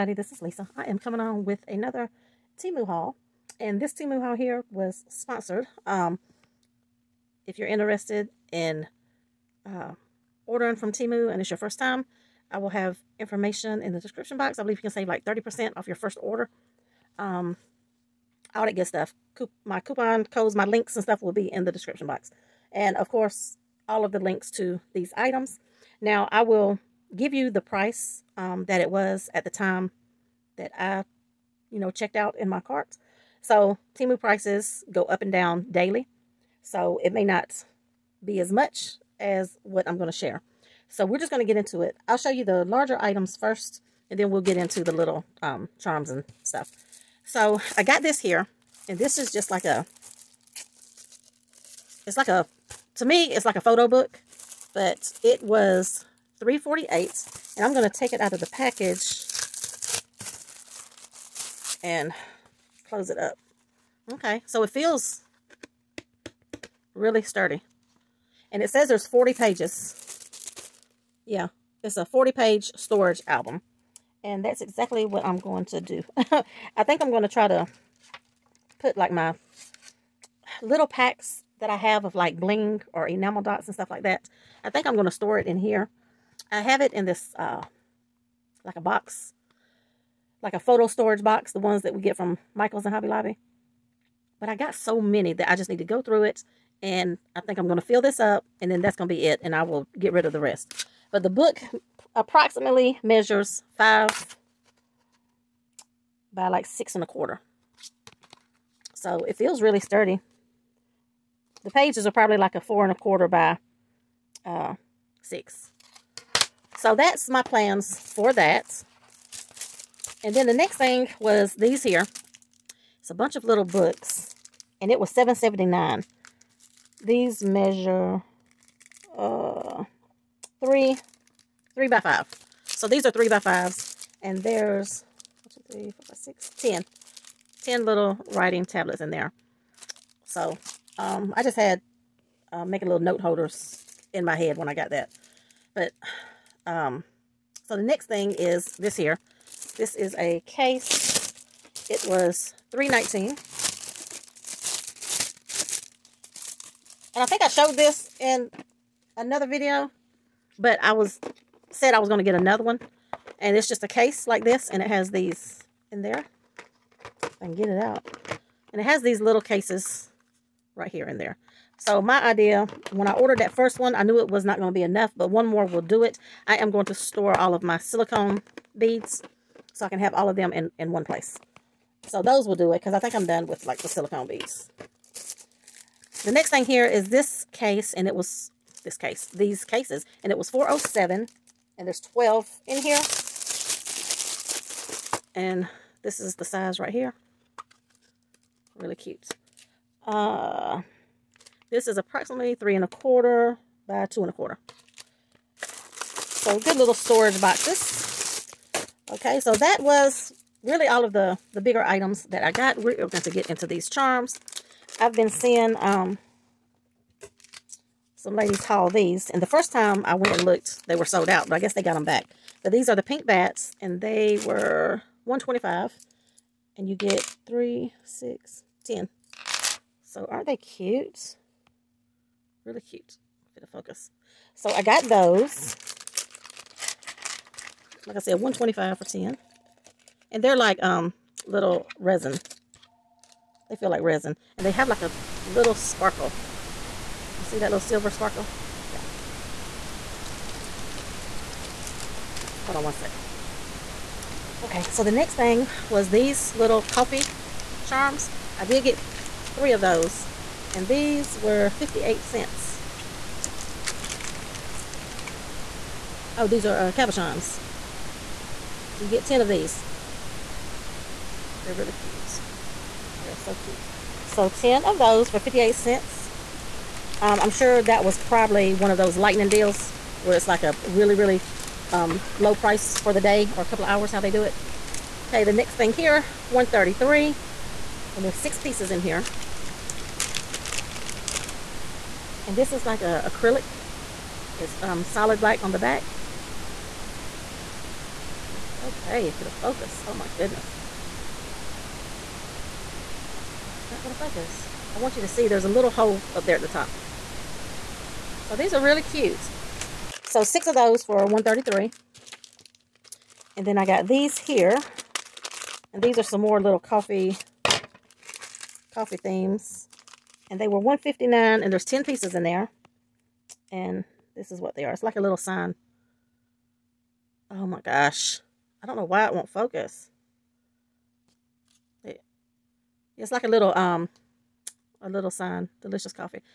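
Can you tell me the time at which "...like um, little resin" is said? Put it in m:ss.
4:00.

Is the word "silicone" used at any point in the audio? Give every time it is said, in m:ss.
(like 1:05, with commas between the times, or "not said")
2:57, 3:03.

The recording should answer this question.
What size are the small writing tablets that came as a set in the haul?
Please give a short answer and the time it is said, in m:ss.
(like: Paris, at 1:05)
3 by 5, at 2:13.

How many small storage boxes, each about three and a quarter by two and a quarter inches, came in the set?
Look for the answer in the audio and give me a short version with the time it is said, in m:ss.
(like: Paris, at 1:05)
12, at 3:11.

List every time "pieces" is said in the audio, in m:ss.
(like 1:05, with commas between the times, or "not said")
4:48, 5:22.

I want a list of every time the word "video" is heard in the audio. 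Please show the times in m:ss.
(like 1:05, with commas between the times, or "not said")
2:39.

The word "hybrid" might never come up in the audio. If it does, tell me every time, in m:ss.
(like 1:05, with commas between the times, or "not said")
not said.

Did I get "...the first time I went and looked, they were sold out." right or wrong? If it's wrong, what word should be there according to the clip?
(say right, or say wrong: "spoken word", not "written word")
right.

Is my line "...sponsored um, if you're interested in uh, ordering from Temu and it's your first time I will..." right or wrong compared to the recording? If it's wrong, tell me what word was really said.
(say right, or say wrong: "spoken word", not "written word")
right.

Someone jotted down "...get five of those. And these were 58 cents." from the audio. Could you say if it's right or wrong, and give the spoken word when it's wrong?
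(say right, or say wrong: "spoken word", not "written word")
wrong: "three", not "five".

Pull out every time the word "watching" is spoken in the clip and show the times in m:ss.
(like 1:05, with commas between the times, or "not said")
not said.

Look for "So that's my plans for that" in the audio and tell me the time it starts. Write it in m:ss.
1:56.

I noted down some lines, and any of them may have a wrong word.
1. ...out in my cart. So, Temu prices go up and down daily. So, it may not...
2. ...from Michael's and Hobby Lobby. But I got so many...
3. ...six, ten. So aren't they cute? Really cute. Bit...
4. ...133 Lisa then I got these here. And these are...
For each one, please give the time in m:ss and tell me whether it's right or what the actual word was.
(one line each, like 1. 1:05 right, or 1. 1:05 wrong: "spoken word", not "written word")
1. 0:32 right
2. 1:32 right
3. 3:48 right
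4. 5:11 wrong: "And", not "Lisa".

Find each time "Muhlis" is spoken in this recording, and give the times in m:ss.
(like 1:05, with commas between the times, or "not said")
not said.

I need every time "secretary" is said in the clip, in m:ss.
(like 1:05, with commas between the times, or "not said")
not said.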